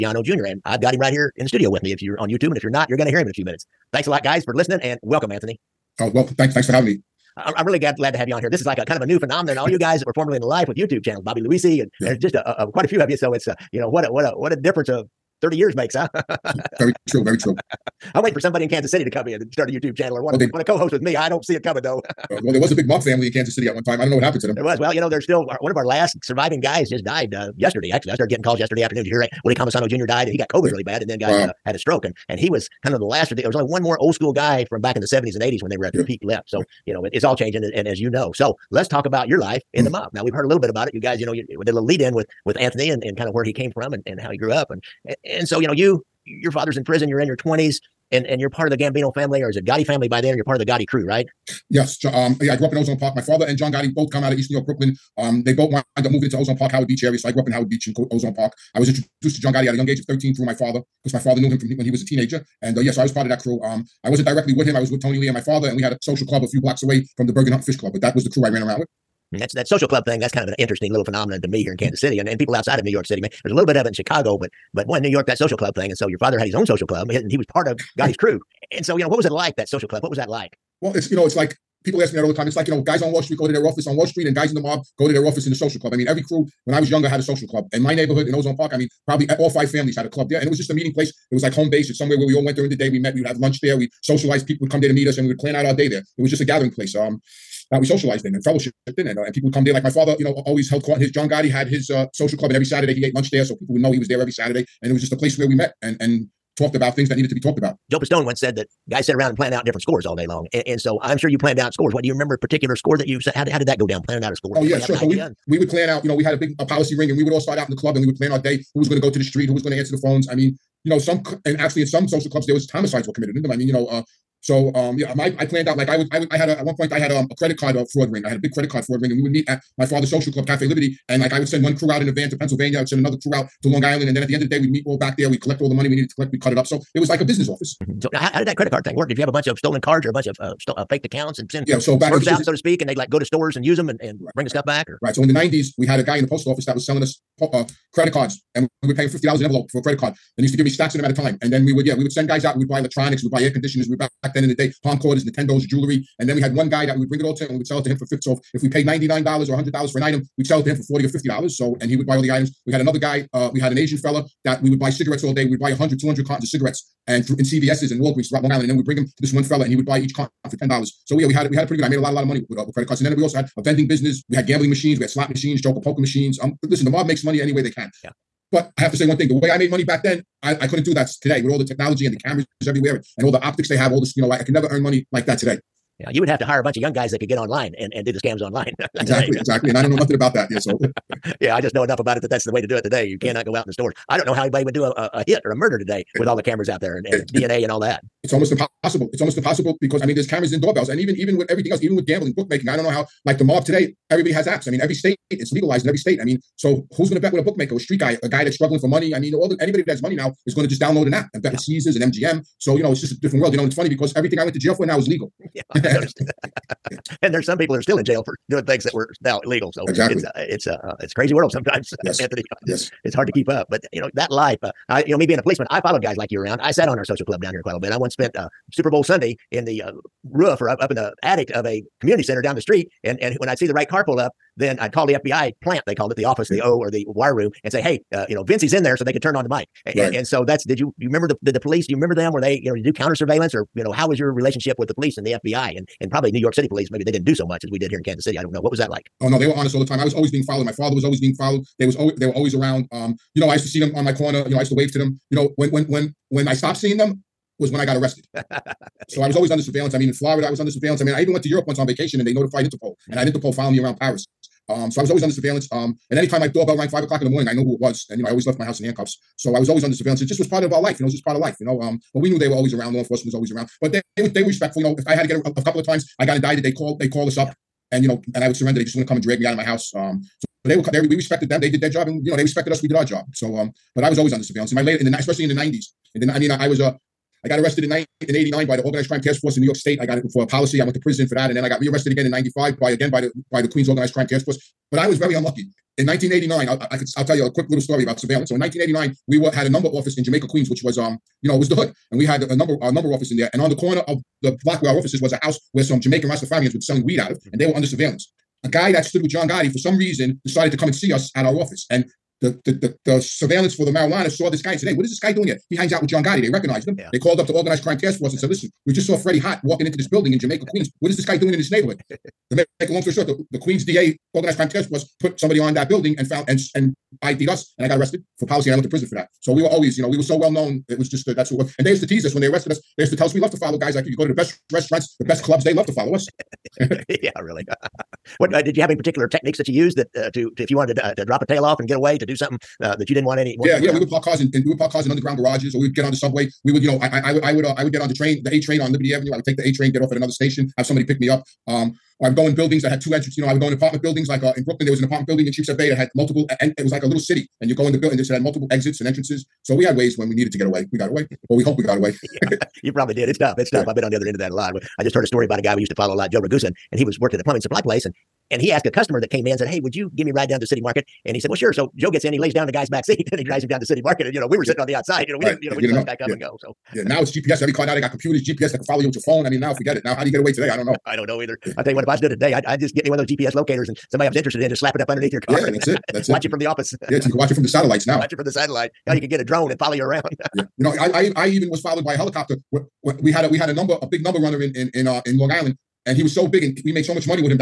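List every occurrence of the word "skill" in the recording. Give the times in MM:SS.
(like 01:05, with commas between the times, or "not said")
not said.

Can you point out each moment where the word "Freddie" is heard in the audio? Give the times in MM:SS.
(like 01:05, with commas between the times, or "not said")
05:19.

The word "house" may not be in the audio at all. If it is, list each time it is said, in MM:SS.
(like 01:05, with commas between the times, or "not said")
04:28, 04:39, 05:05.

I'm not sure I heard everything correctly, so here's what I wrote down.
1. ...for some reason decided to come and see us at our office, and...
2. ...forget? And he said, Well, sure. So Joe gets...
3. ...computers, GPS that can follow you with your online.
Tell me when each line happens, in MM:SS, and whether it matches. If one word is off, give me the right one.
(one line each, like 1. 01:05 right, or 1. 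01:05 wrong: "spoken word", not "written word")
1. 05:09 right
2. 06:10 wrong: "market", not "forget"
3. 06:18 wrong: "phone", not "online".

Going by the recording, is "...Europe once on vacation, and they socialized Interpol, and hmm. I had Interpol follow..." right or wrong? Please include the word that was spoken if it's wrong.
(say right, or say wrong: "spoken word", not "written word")
wrong: "notified", not "socialized".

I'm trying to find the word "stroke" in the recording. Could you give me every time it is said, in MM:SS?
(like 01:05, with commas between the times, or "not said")
00:31.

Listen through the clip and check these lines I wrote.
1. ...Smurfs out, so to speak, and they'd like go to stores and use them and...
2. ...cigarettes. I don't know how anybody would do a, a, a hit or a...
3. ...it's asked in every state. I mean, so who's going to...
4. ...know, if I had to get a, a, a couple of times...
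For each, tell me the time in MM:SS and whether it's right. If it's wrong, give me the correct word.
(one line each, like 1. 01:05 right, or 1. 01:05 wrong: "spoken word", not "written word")
1. 02:22 right
2. 03:13 wrong: "stores", not "cigarettes"
3. 03:25 wrong: "legalized", not "asked"
4. 04:34 right.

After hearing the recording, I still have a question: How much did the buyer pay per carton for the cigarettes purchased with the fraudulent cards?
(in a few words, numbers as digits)
$10.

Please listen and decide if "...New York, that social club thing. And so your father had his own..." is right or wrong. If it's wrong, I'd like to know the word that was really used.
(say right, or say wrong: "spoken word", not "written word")
right.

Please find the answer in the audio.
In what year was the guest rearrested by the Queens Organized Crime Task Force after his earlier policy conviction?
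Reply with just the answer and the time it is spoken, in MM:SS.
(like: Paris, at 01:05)
1995, at 04:52.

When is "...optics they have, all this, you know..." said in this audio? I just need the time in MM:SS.
03:03.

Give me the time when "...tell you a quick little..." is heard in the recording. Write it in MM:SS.
04:57.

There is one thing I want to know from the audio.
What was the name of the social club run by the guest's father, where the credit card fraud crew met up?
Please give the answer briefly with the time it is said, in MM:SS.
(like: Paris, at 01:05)
Cafe Liberty, at 02:10.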